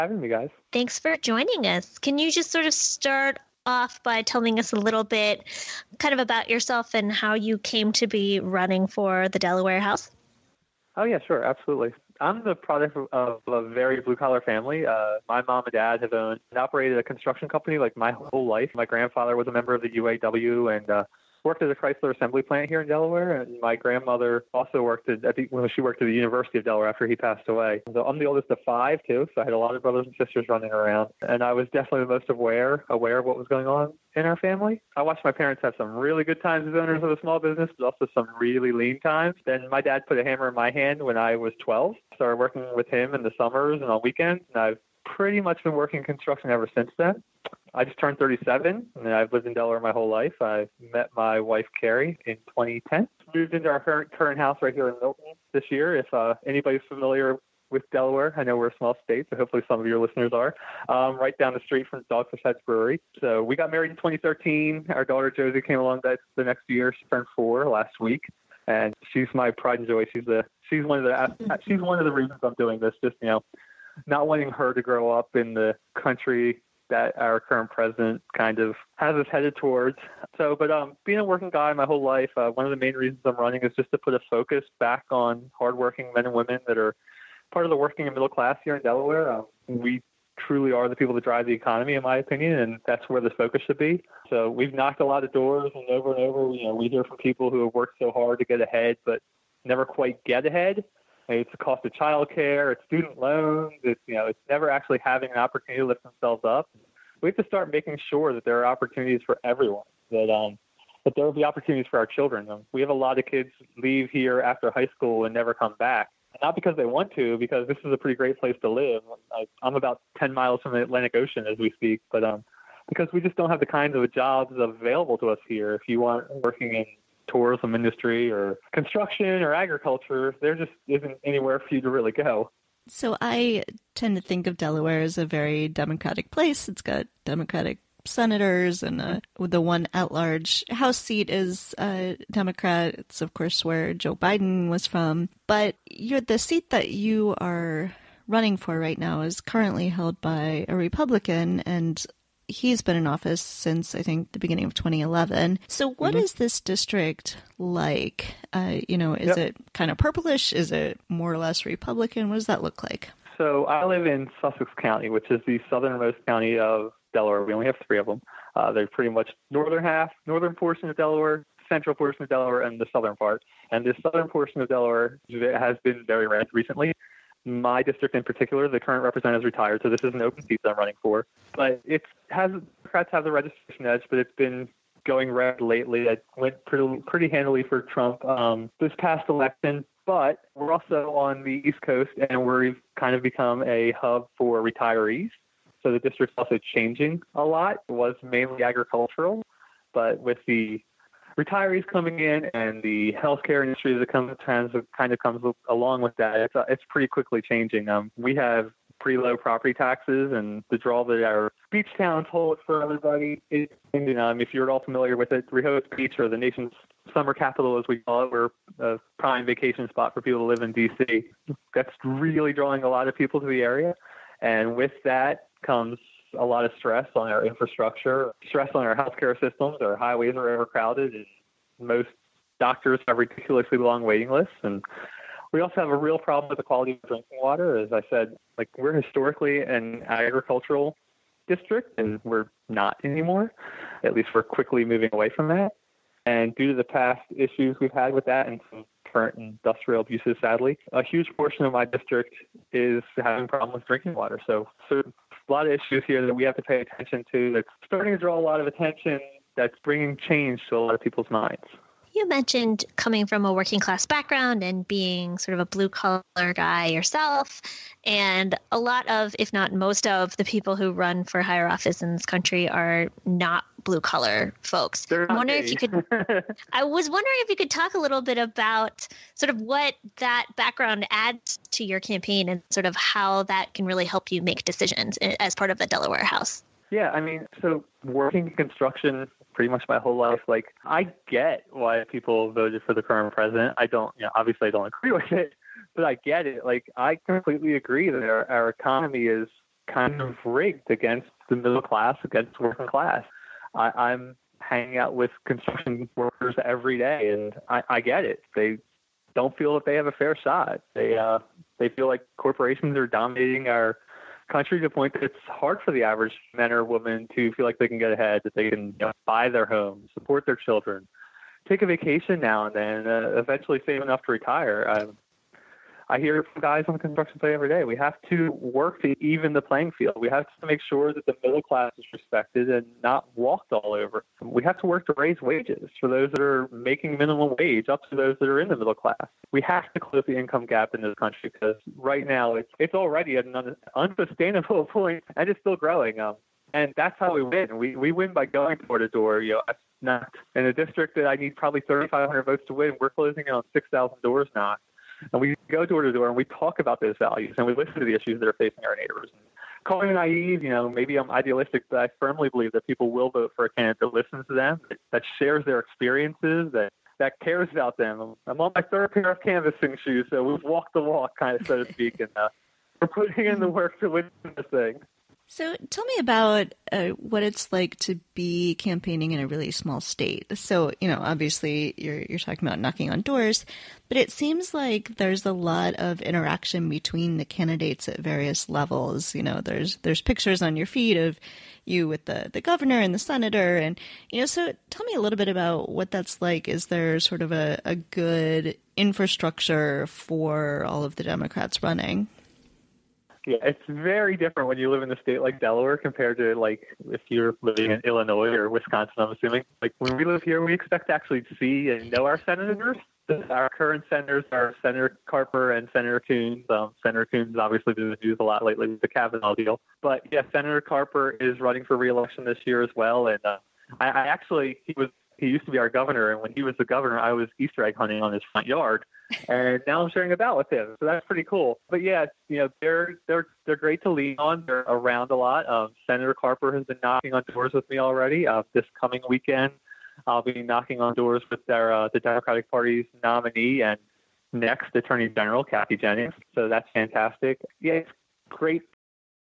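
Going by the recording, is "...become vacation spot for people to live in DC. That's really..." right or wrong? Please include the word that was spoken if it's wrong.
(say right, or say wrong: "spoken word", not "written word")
wrong: "prime", not "become".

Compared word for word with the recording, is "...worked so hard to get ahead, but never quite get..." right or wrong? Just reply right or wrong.
right.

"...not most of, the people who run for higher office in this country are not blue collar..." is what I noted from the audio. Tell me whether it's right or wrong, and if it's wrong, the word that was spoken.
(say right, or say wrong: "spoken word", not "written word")
right.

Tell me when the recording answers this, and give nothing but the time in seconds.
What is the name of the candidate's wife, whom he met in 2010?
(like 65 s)
51 s.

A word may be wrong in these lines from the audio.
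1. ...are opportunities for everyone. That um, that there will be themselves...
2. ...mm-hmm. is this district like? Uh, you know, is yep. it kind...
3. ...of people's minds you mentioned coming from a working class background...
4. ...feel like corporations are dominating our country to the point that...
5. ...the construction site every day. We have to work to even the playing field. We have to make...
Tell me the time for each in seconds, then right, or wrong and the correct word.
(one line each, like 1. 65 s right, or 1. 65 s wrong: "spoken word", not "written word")
1. 108 s wrong: "opportunities", not "themselves"
2. 156 s right
3. 260 s right
4. 311 s right
5. 326 s right.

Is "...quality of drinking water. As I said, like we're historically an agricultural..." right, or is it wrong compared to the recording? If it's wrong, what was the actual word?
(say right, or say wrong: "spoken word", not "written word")
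right.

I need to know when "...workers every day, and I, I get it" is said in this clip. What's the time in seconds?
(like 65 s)
306 s.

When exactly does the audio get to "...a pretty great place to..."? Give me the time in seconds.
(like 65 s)
117 s.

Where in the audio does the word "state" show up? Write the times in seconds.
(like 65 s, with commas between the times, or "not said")
59 s, 379 s, 405 s.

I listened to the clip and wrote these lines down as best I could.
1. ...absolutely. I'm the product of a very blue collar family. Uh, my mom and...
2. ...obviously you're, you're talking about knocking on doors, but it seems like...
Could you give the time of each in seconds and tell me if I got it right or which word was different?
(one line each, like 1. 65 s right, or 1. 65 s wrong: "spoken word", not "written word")
1. 11 s right
2. 381 s right.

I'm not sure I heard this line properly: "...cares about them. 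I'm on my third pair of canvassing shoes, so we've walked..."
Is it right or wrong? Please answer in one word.
right.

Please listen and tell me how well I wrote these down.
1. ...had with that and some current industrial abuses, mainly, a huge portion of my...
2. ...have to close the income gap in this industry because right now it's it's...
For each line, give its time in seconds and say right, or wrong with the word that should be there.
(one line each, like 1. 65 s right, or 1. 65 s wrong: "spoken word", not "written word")
1. 247 s wrong: "sadly", not "mainly"
2. 339 s wrong: "country", not "industry".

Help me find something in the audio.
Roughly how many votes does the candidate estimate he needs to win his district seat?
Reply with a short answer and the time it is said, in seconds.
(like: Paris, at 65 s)
3,500, at 351 s.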